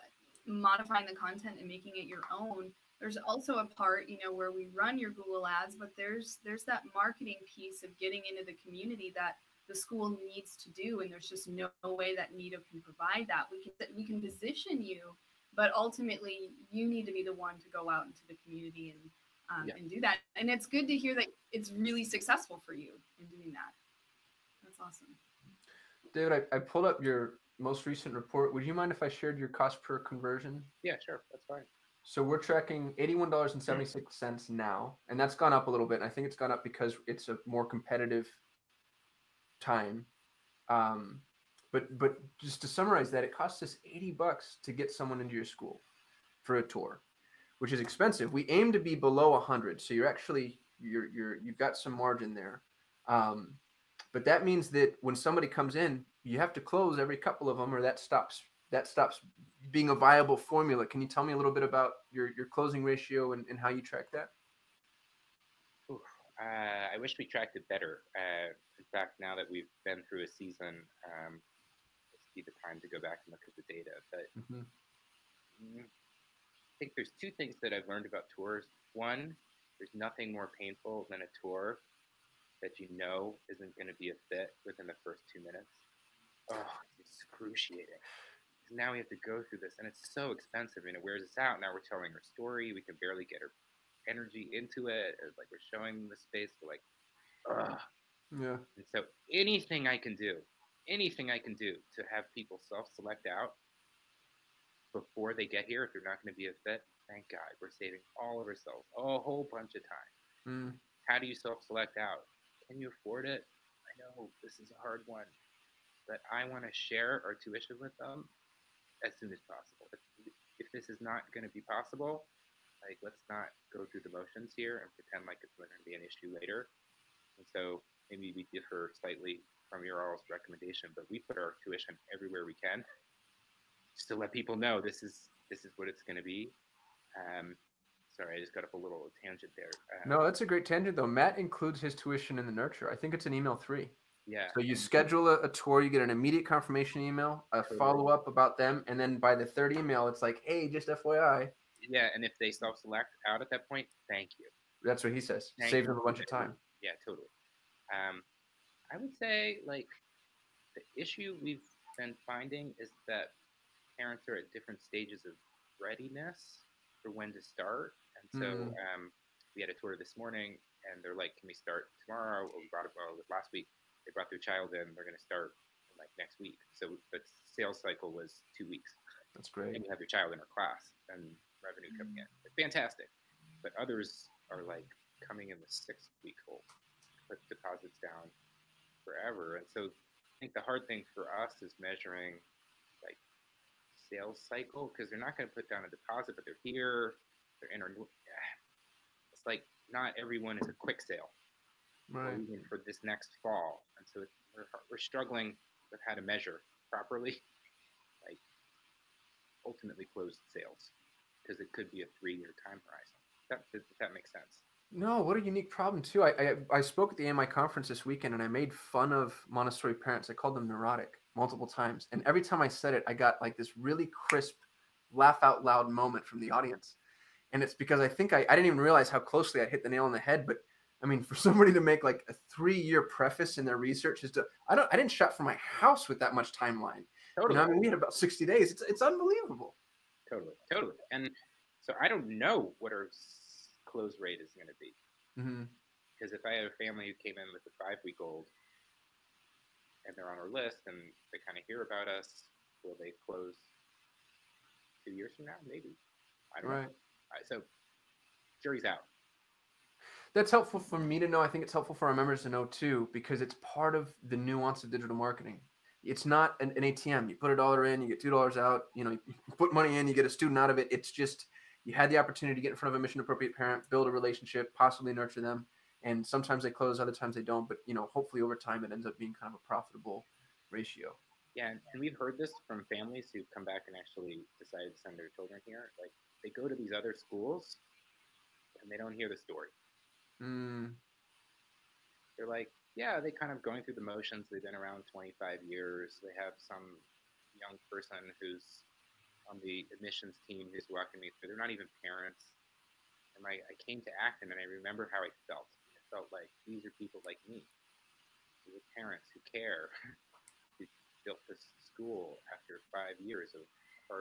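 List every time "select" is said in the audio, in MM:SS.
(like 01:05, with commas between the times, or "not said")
01:42, 01:51, 02:32.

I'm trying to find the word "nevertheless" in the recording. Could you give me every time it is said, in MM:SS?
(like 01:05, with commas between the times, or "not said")
not said.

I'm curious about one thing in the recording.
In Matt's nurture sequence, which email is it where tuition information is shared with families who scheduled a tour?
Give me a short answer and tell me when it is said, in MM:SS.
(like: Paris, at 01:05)
Email three, at 02:23.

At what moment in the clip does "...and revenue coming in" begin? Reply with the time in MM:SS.
03:01.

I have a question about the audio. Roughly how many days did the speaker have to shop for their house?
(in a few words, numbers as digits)
60.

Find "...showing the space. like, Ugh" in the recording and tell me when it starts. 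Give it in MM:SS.
01:35.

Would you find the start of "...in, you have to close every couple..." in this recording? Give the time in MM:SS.
00:55.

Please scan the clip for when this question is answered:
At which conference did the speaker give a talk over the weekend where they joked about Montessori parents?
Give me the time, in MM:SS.
03:37.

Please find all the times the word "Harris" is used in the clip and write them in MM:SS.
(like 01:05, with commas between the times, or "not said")
not said.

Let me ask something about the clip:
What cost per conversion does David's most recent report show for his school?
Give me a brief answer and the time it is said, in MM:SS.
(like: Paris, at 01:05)
$81.76, at 00:32.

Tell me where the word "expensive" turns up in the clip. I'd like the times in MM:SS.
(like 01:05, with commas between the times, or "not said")
00:47, 01:30.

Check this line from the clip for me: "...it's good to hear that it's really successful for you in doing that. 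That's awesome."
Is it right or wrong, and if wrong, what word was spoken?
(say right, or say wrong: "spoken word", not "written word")
right.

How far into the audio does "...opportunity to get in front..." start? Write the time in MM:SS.
04:32.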